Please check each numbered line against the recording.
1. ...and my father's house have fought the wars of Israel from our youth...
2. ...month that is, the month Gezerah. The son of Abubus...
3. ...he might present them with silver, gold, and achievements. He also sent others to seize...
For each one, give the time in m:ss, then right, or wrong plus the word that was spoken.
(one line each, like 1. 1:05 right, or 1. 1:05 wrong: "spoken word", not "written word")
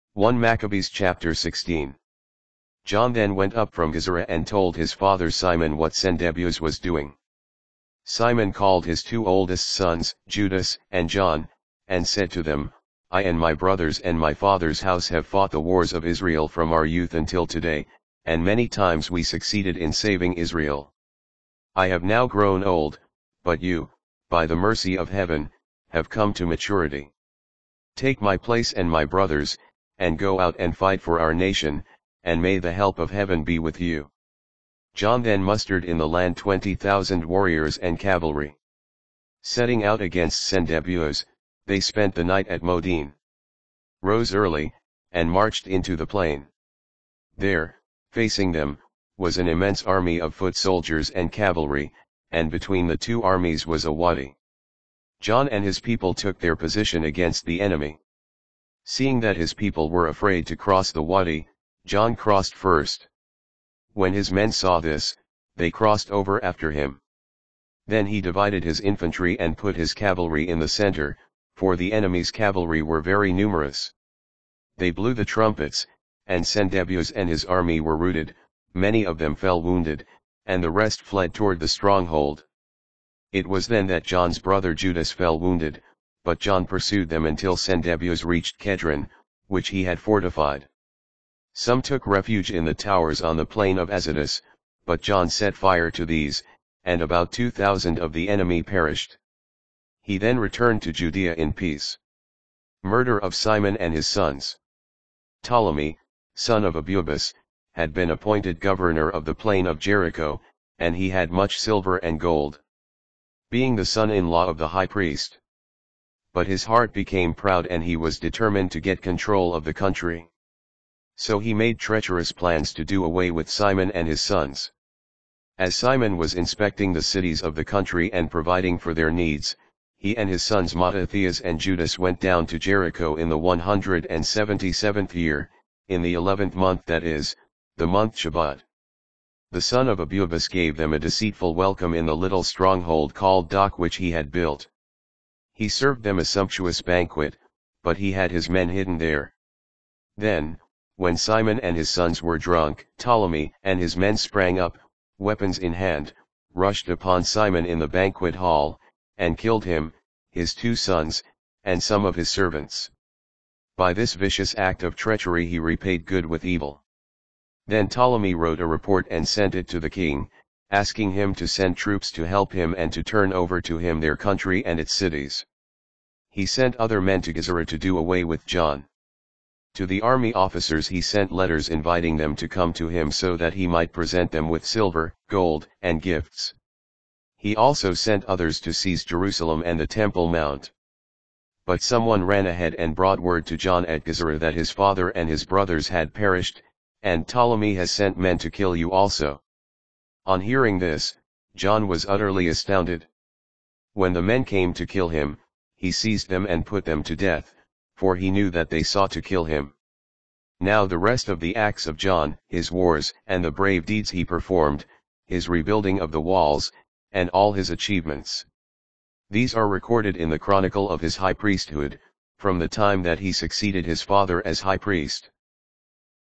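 1. 0:13 right
2. 2:16 wrong: "Shabbat", not "Gezerah"
3. 3:03 wrong: "gifts", not "achievements".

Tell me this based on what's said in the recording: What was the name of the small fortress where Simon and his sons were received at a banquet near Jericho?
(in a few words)
Dok.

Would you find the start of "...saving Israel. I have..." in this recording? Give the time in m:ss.
0:19.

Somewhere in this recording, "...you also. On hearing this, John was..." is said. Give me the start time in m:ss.
3:18.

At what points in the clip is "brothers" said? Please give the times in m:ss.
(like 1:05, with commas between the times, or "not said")
0:13, 0:29, 1:24, 3:15.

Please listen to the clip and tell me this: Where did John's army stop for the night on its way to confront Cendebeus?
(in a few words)
Modein.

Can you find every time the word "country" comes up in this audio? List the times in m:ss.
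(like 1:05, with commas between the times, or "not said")
1:59, 2:07, 2:54.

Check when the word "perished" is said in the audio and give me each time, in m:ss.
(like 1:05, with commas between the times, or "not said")
1:38, 3:16.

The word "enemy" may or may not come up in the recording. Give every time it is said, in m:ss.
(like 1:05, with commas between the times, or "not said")
0:57, 1:11, 1:38.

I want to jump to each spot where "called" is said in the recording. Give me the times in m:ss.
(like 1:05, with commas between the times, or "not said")
0:08, 2:23.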